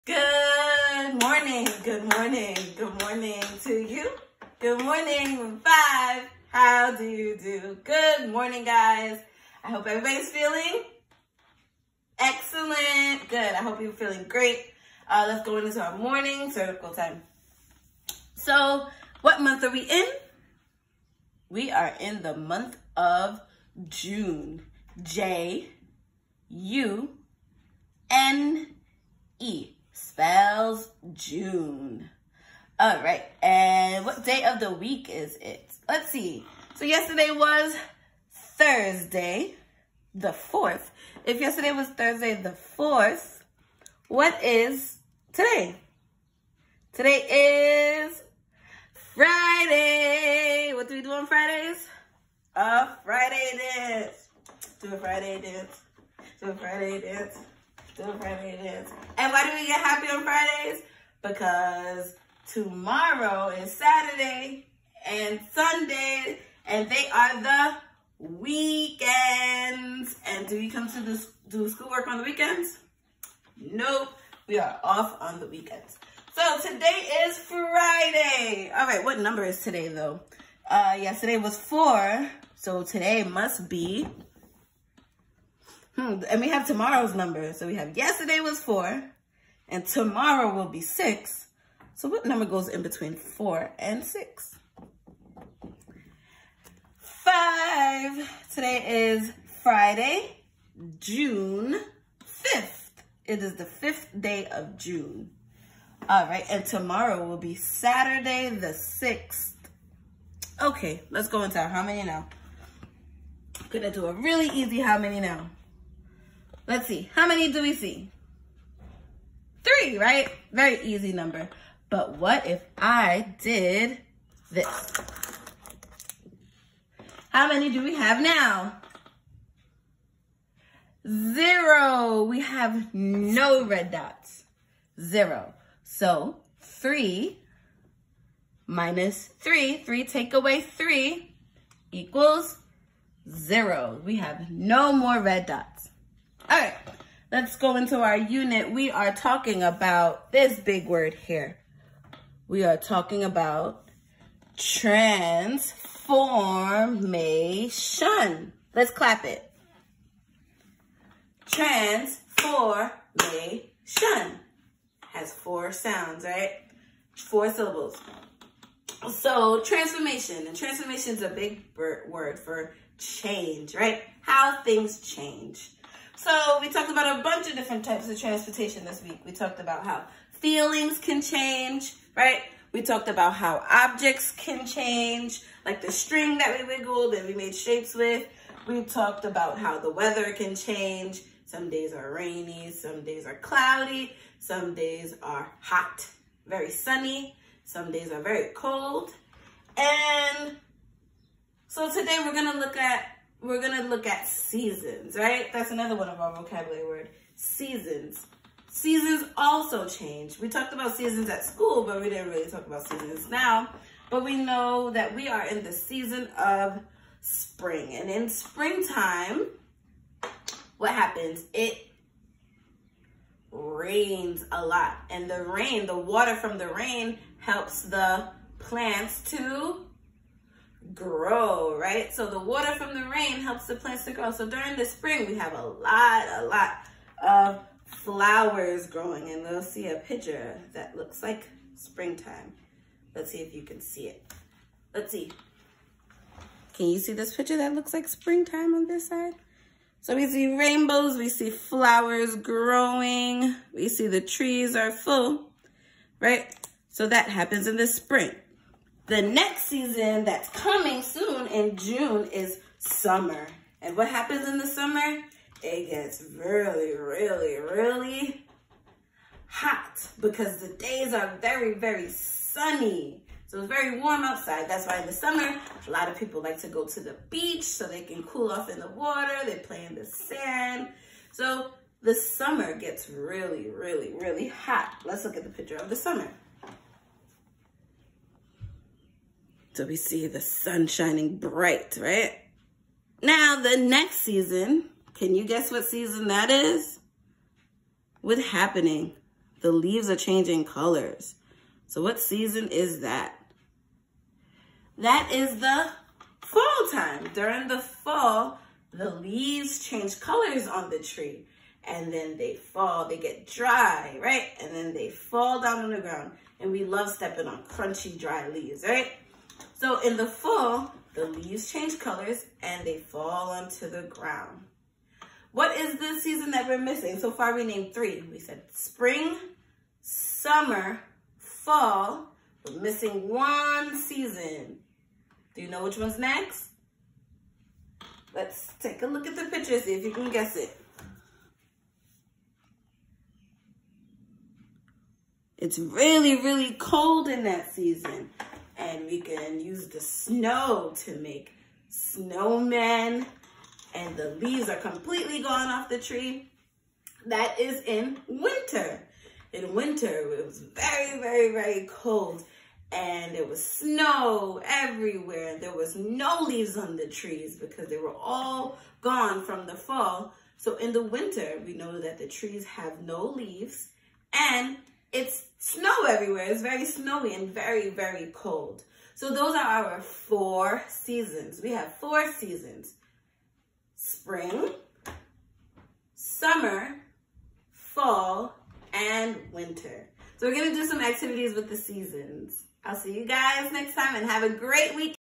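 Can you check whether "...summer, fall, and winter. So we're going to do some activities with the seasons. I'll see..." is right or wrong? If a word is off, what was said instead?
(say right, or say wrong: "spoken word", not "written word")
right.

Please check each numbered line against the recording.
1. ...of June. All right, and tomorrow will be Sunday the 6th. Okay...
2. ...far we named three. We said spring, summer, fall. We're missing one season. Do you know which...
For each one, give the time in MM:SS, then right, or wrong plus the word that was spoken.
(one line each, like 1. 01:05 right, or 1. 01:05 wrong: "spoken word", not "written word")
1. 01:44 wrong: "Saturday", not "Sunday"
2. 05:27 right.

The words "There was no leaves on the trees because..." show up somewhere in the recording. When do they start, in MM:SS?
06:05.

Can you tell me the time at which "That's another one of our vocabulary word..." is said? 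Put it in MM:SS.
03:25.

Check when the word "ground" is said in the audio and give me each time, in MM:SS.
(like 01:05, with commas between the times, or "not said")
05:16, 05:24.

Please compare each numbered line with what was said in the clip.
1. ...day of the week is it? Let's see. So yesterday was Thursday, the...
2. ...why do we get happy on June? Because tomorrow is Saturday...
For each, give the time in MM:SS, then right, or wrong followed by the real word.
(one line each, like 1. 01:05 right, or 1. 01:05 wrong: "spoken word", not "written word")
1. 00:34 right
2. 00:59 wrong: "Fridays", not "June".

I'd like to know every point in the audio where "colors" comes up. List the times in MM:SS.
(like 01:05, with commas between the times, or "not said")
05:00, 05:10, 05:21.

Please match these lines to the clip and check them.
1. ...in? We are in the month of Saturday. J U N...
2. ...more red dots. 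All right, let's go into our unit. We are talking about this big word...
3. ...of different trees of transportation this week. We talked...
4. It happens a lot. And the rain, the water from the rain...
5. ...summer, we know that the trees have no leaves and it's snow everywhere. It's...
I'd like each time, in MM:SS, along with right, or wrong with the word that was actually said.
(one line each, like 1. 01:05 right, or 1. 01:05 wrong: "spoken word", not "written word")
1. 00:19 wrong: "June", not "Saturday"
2. 02:24 right
3. 02:57 wrong: "types", not "trees"
4. 03:41 wrong: "rains", not "happens"
5. 06:11 wrong: "winter", not "summer".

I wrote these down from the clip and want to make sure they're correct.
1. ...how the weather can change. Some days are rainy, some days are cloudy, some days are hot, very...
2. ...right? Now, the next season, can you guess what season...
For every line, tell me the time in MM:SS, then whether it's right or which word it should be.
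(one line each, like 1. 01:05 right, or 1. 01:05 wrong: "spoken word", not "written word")
1. 03:09 right
2. 04:51 right.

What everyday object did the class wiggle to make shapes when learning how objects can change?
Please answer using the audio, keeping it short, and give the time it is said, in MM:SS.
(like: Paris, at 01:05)
string, at 03:05.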